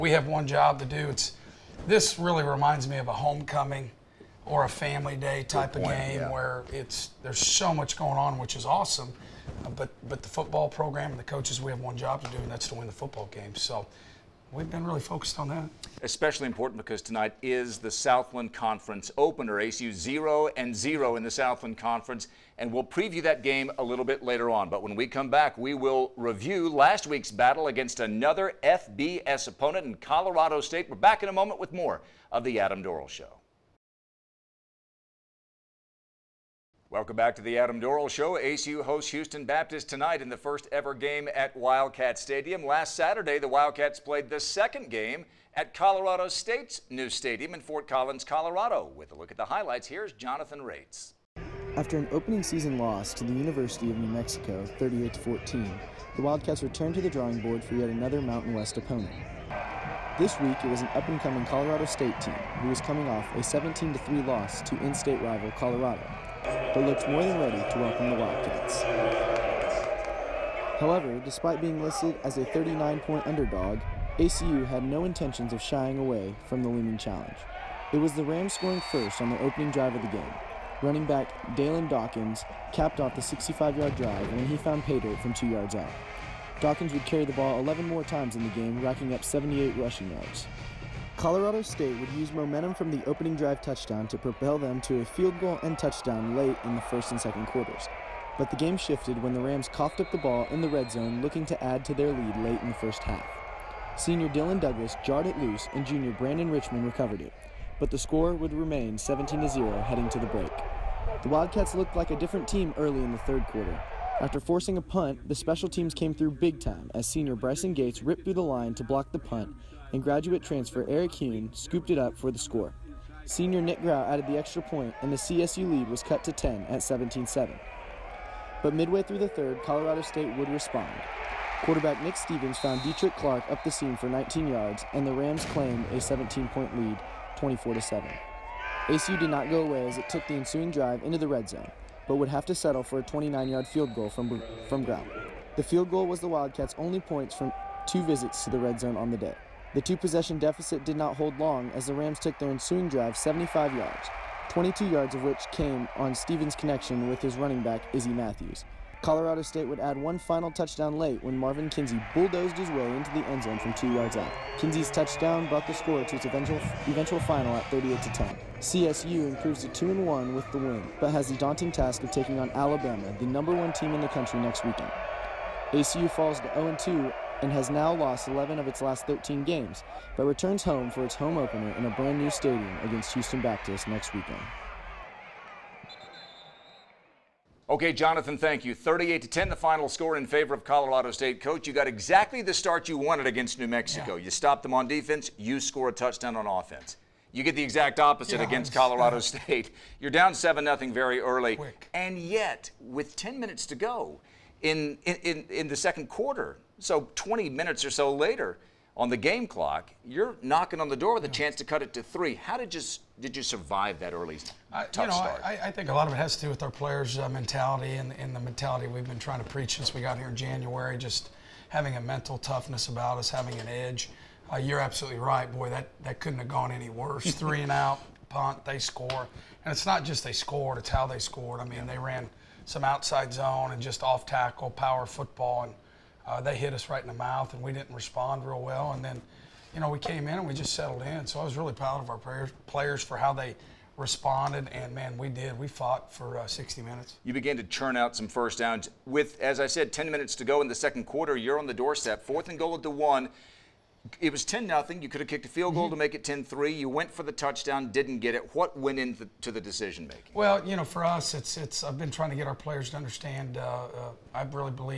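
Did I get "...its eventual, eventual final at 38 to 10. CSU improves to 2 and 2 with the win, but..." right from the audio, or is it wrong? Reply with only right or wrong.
wrong.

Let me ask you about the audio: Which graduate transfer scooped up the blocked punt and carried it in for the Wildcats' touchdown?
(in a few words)
Eric Hune.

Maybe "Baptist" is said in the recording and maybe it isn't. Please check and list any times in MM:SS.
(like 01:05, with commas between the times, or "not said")
00:39, 03:03.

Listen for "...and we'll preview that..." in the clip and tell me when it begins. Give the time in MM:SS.
00:22.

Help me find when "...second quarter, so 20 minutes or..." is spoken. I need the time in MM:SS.
03:25.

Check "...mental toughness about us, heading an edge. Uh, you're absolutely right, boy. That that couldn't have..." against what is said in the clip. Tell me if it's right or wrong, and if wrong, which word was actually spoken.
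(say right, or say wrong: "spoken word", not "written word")
wrong: "having", not "heading".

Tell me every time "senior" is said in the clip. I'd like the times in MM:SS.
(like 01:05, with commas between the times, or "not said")
01:43, 01:57, 02:03.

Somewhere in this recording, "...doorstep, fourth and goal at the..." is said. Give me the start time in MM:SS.
04:11.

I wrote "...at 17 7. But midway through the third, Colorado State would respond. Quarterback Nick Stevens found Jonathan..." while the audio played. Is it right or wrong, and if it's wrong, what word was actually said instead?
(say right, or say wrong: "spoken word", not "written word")
wrong: "Detrich", not "Jonathan".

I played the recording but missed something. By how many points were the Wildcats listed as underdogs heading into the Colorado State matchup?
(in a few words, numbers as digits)
39.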